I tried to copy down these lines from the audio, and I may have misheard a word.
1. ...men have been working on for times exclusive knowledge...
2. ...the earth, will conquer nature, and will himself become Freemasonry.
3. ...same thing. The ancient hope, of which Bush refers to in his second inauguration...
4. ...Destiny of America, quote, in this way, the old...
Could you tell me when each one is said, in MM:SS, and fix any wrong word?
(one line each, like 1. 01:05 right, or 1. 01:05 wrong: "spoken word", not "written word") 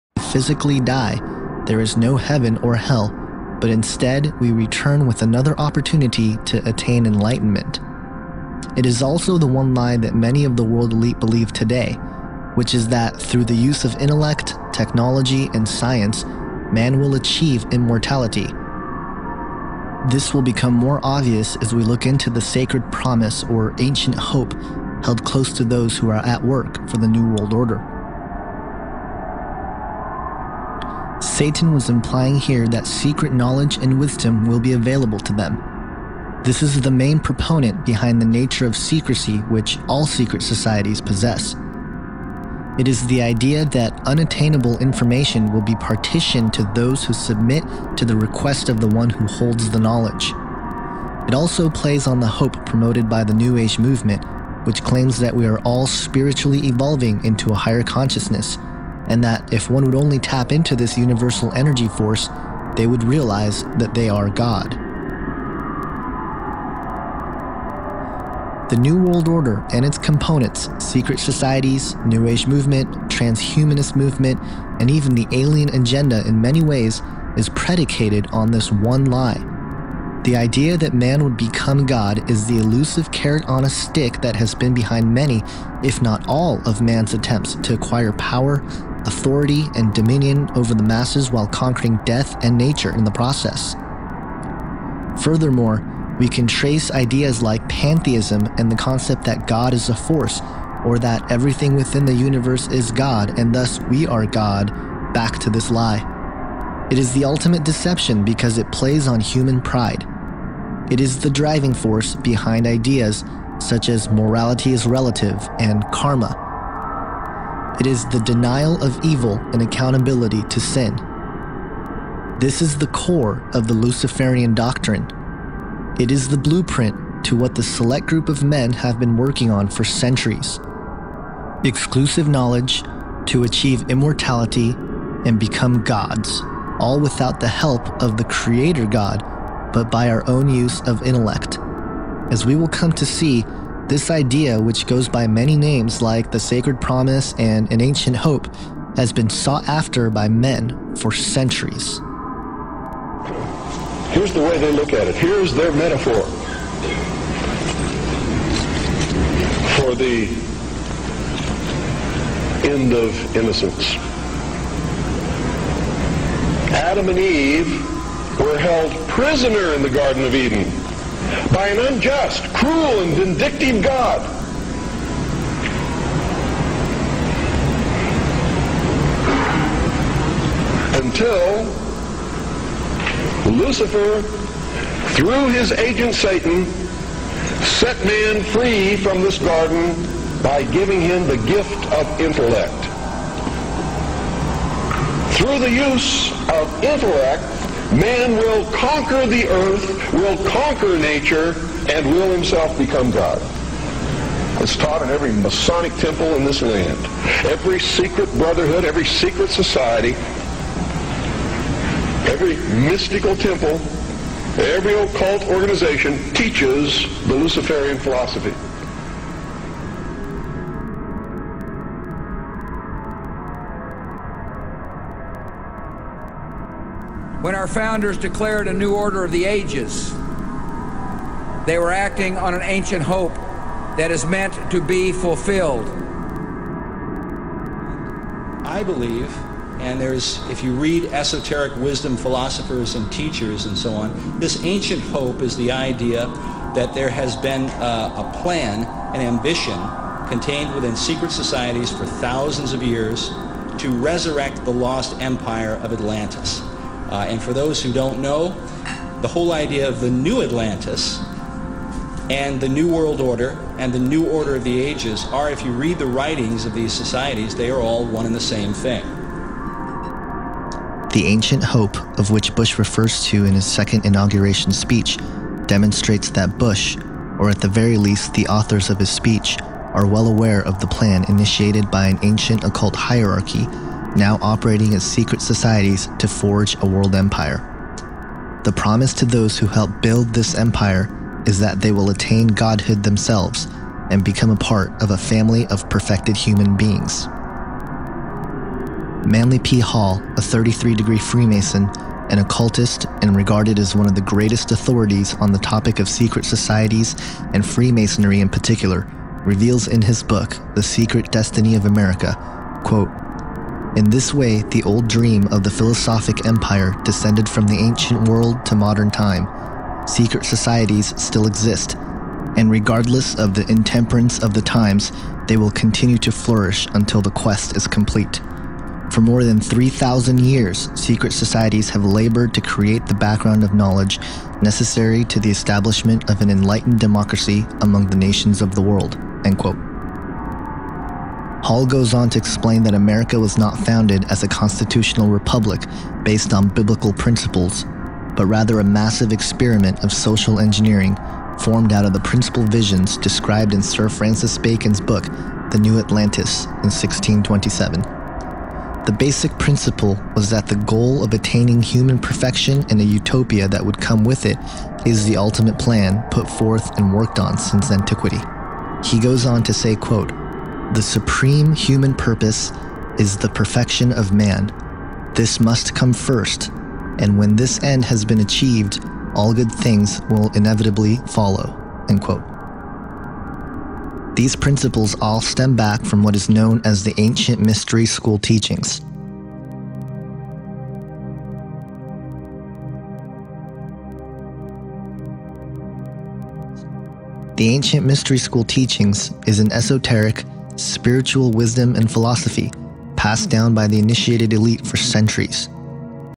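1. 02:08 wrong: "centuries", not "times"
2. 03:19 wrong: "God", not "Freemasonry"
3. 04:28 right
4. 05:11 right.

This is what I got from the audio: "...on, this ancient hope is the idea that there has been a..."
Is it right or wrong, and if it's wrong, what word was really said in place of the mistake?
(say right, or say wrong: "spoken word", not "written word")
right.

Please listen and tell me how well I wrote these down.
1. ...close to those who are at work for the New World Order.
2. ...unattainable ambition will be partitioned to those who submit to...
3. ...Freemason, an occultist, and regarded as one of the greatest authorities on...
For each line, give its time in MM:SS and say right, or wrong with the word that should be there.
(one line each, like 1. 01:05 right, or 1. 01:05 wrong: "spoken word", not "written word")
1. 00:25 right
2. 00:44 wrong: "information", not "ambition"
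3. 05:01 right.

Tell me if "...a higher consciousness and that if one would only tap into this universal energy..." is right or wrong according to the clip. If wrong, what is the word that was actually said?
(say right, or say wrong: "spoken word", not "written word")
right.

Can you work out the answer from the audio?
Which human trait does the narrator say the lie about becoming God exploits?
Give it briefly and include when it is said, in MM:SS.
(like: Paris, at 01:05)
human pride, at 01:49.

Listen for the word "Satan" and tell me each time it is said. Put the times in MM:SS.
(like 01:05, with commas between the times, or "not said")
00:31, 03:06.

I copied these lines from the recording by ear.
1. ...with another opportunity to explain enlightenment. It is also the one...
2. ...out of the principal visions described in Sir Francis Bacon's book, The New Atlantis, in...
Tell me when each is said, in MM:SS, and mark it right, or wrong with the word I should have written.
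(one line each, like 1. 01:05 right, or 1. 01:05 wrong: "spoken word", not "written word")
1. 00:05 wrong: "attain", not "explain"
2. 05:51 right.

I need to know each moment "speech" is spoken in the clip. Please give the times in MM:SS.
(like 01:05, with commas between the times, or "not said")
04:34, 04:39.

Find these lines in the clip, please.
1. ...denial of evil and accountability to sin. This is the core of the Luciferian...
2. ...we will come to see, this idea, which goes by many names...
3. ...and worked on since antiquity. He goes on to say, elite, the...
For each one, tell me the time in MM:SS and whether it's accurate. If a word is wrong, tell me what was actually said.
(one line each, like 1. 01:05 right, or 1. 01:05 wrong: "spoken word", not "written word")
1. 01:58 right
2. 02:22 right
3. 06:06 wrong: "quote", not "elite".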